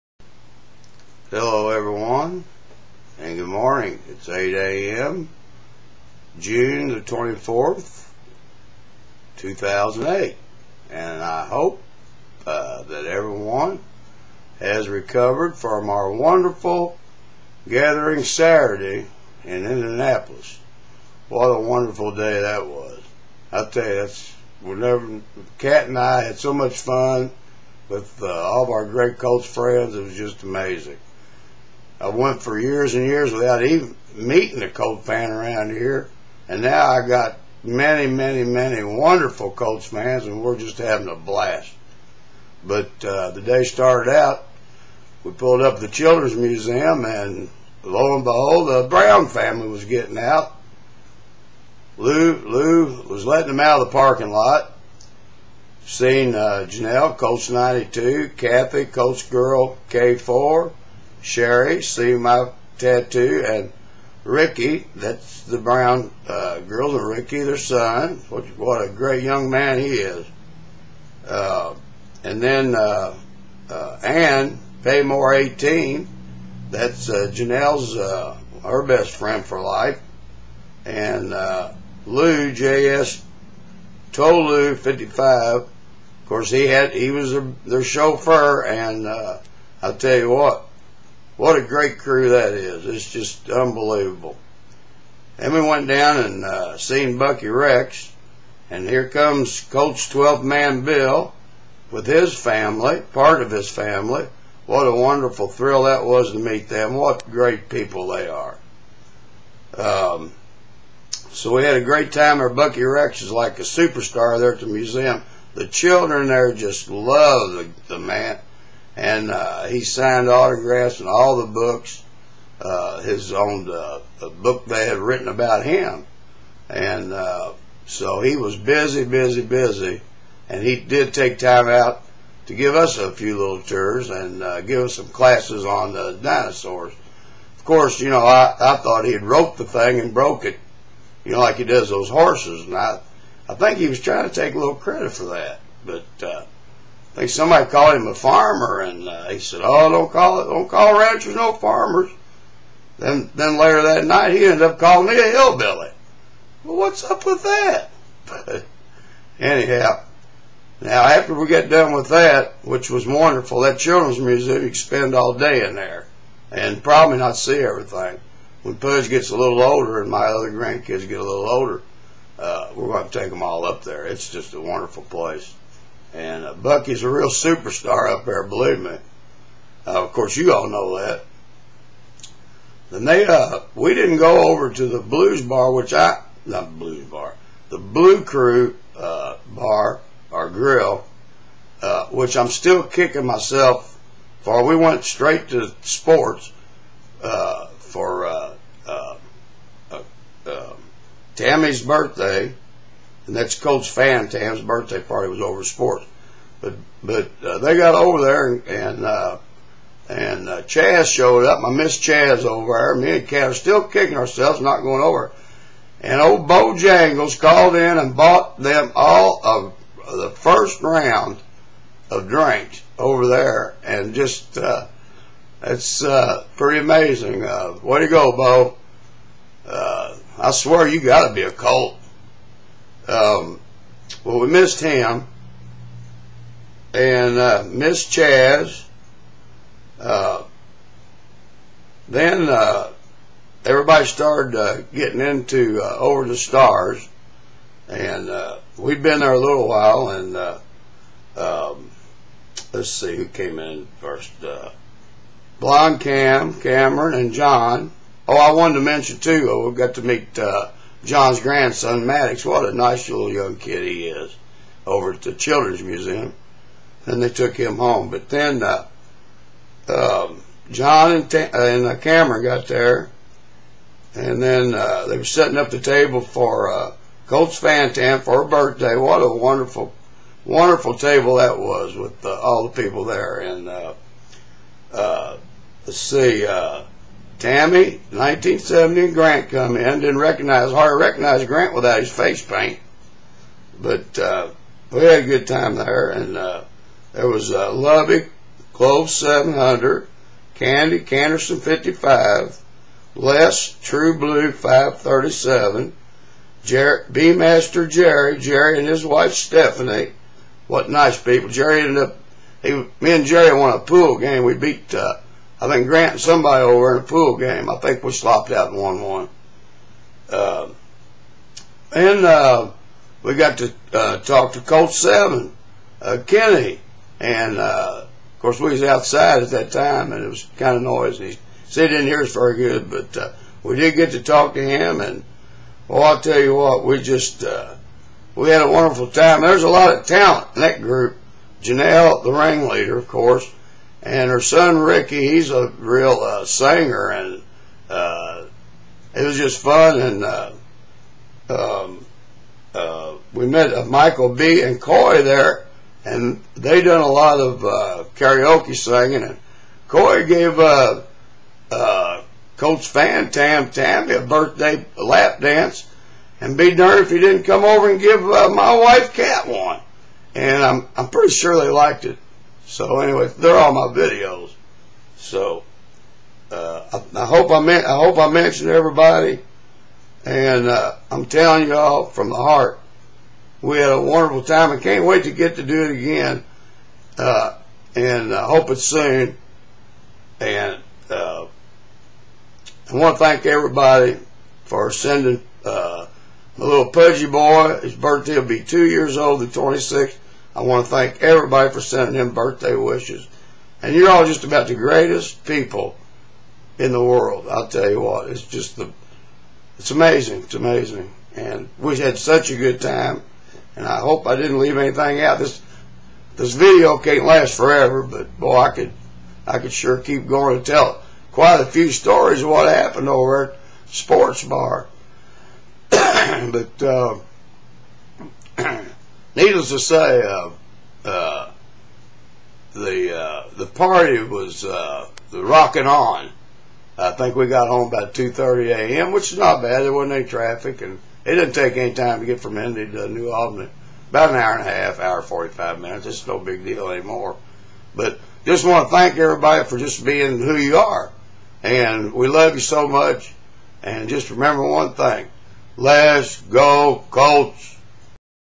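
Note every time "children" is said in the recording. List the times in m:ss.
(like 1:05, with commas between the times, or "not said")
0:45, 1:55, 2:43, 4:25.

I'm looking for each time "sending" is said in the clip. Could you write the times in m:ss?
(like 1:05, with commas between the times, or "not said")
6:34, 6:41.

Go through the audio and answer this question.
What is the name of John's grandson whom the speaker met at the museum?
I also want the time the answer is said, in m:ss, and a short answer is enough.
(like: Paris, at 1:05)
Maddox, at 4:22.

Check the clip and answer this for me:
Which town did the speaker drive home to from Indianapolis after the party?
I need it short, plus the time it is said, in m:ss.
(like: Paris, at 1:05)
New Albany, at 7:23.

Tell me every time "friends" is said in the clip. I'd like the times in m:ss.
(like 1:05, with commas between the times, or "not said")
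0:29, 1:19.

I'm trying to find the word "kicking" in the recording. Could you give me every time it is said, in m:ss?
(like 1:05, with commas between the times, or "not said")
3:12, 3:33.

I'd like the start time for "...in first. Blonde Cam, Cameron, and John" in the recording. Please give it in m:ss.
4:13.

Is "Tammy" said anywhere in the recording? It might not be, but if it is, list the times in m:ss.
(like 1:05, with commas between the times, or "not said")
3:21, 4:47, 6:03.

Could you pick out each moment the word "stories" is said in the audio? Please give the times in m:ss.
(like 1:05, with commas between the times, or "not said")
7:01.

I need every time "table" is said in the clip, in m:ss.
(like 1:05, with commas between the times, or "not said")
4:35, 4:40.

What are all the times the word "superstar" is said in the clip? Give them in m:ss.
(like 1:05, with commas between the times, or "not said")
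1:53, 2:57.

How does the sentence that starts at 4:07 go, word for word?
And uh, we'd been there a little while.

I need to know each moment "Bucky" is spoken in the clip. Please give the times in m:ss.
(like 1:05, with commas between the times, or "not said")
1:37, 1:52, 2:56.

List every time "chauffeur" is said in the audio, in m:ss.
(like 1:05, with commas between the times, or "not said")
1:27.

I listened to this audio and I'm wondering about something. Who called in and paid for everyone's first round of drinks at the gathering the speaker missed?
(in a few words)
Bojangles.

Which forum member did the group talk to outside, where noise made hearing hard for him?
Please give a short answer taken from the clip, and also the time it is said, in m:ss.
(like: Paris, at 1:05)
Colts Seven, at 5:24.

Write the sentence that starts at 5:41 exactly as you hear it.
Janelle, the ringleader, of course and her son Ricky, he's a real uh, singer, and uh, it was just fun.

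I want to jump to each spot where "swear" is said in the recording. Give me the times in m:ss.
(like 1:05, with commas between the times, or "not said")
3:50.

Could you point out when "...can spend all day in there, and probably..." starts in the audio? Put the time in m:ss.
2:44.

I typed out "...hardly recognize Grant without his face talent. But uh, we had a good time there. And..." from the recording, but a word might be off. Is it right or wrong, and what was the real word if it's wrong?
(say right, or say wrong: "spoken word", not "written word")
wrong: "paint", not "talent".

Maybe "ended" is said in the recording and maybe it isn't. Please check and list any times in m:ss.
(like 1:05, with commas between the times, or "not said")
2:34, 5:11.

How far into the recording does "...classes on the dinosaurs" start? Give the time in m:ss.
2:15.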